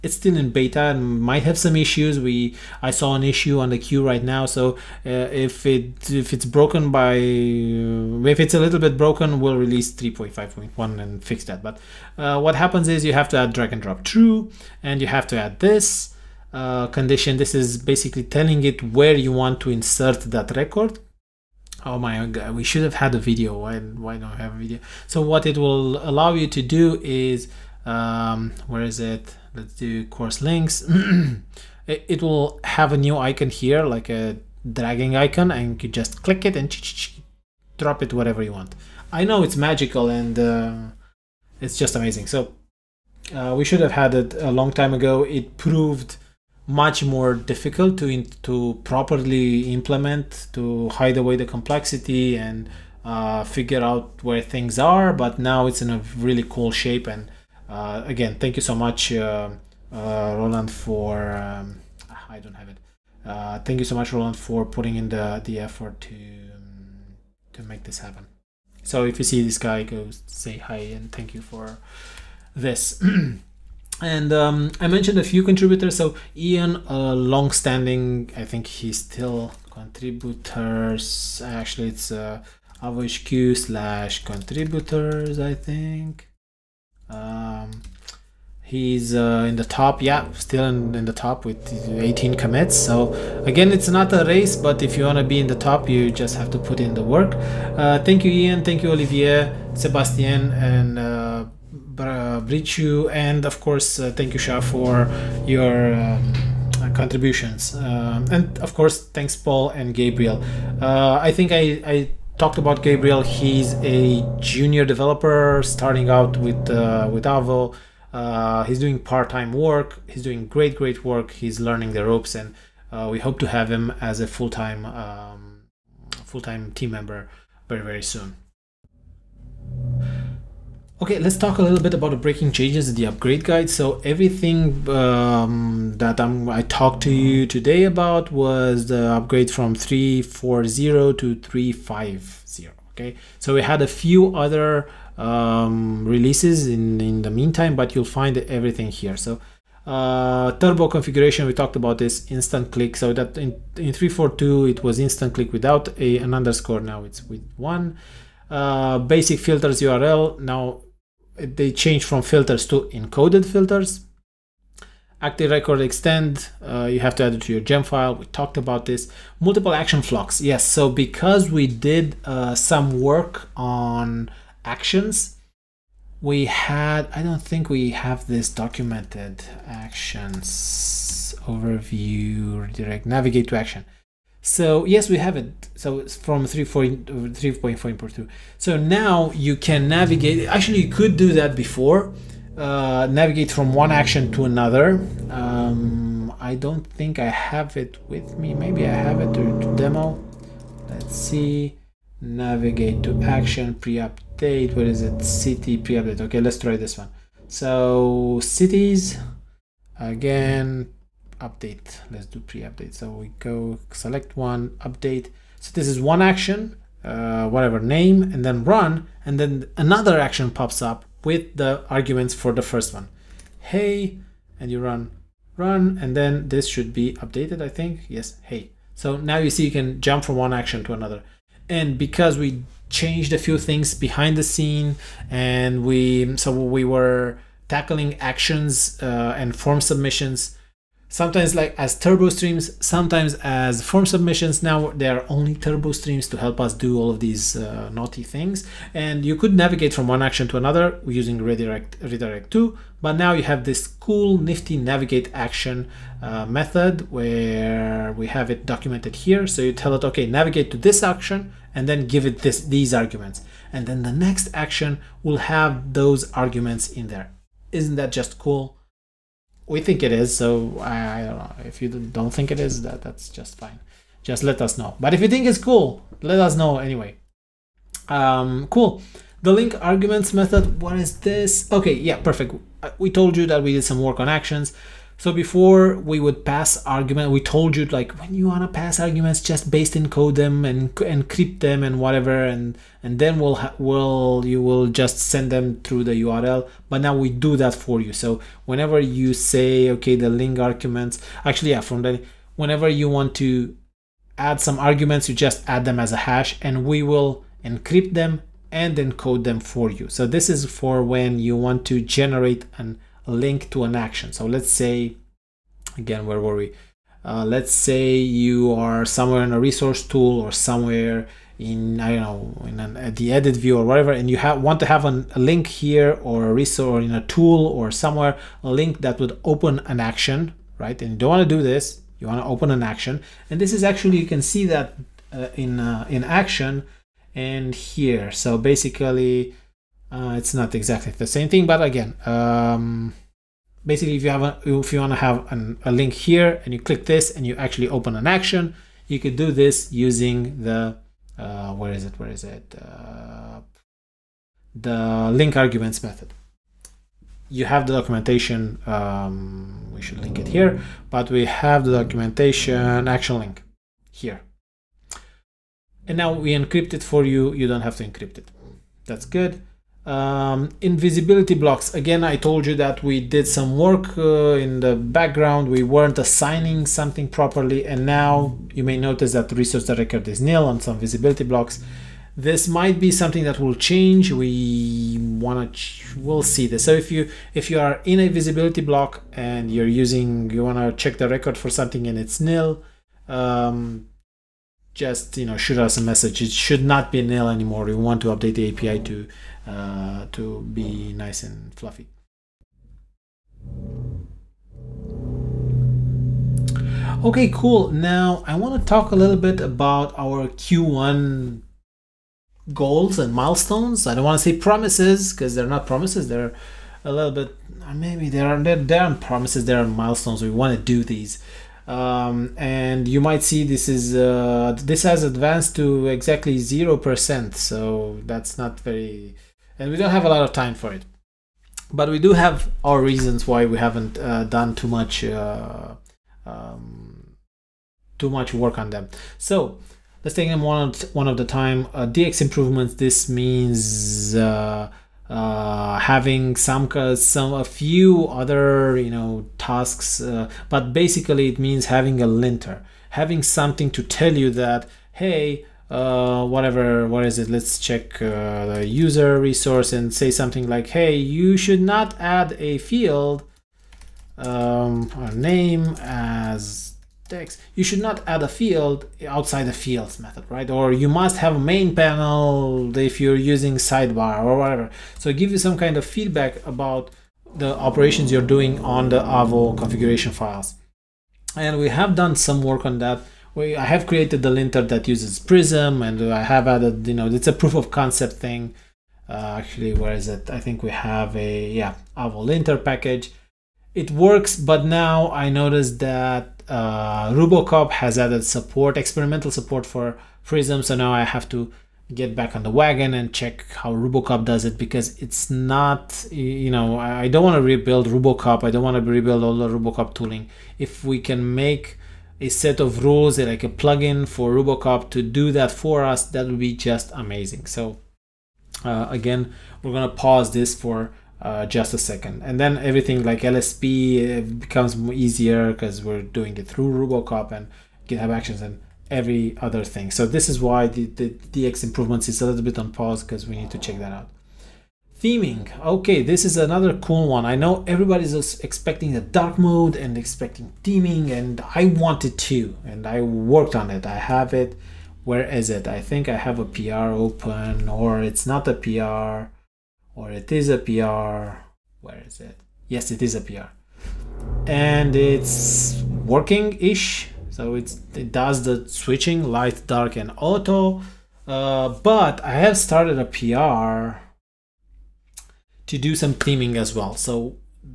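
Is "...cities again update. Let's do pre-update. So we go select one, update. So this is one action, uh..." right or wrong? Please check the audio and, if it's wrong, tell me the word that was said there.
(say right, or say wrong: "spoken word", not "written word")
right.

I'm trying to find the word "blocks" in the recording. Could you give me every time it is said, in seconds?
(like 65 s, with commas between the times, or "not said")
371 s, 381 s, 388 s.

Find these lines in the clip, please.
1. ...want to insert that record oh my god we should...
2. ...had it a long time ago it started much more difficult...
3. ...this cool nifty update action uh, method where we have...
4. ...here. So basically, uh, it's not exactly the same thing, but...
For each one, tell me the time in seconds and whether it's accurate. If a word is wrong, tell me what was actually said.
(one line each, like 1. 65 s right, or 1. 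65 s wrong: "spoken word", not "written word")
1. 19 s right
2. 43 s wrong: "proved", not "started"
3. 253 s wrong: "navigate", not "update"
4. 337 s right.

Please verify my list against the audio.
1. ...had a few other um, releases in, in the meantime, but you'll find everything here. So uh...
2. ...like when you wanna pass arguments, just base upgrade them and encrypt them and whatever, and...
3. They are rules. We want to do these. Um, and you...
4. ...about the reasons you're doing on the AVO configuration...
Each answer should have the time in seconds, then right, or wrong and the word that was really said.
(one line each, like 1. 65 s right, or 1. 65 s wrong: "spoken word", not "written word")
1. 143 s right
2. 287 s wrong: "encode", not "upgrade"
3. 419 s wrong: "milestones", not "rules"
4. 476 s wrong: "operations", not "reasons".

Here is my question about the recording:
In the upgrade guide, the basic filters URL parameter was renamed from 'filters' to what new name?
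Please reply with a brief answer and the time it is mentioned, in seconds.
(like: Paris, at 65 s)
encoded filters, at 162 s.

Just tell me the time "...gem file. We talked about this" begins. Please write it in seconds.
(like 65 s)
167 s.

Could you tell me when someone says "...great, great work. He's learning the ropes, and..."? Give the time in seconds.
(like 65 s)
120 s.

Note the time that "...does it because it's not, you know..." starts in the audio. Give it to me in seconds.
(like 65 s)
504 s.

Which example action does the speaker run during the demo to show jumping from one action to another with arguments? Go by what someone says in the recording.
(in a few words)
City pre-update.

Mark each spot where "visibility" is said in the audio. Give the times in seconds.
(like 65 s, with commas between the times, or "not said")
370 s, 380 s, 388 s.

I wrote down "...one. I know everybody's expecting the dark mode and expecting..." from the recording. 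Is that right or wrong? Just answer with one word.
right.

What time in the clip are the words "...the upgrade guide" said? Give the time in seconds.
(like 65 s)
132 s.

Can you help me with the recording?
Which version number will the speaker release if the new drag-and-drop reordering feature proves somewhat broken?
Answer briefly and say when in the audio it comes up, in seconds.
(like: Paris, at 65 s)
3.5.1, at 9 s.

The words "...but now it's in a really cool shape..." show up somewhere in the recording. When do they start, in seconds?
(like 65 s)
55 s.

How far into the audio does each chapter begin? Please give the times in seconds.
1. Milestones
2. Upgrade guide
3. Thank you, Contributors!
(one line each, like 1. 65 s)
1. 402 s
2. 128 s
3. 72 s.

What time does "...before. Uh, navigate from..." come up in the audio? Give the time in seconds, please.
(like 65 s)
191 s.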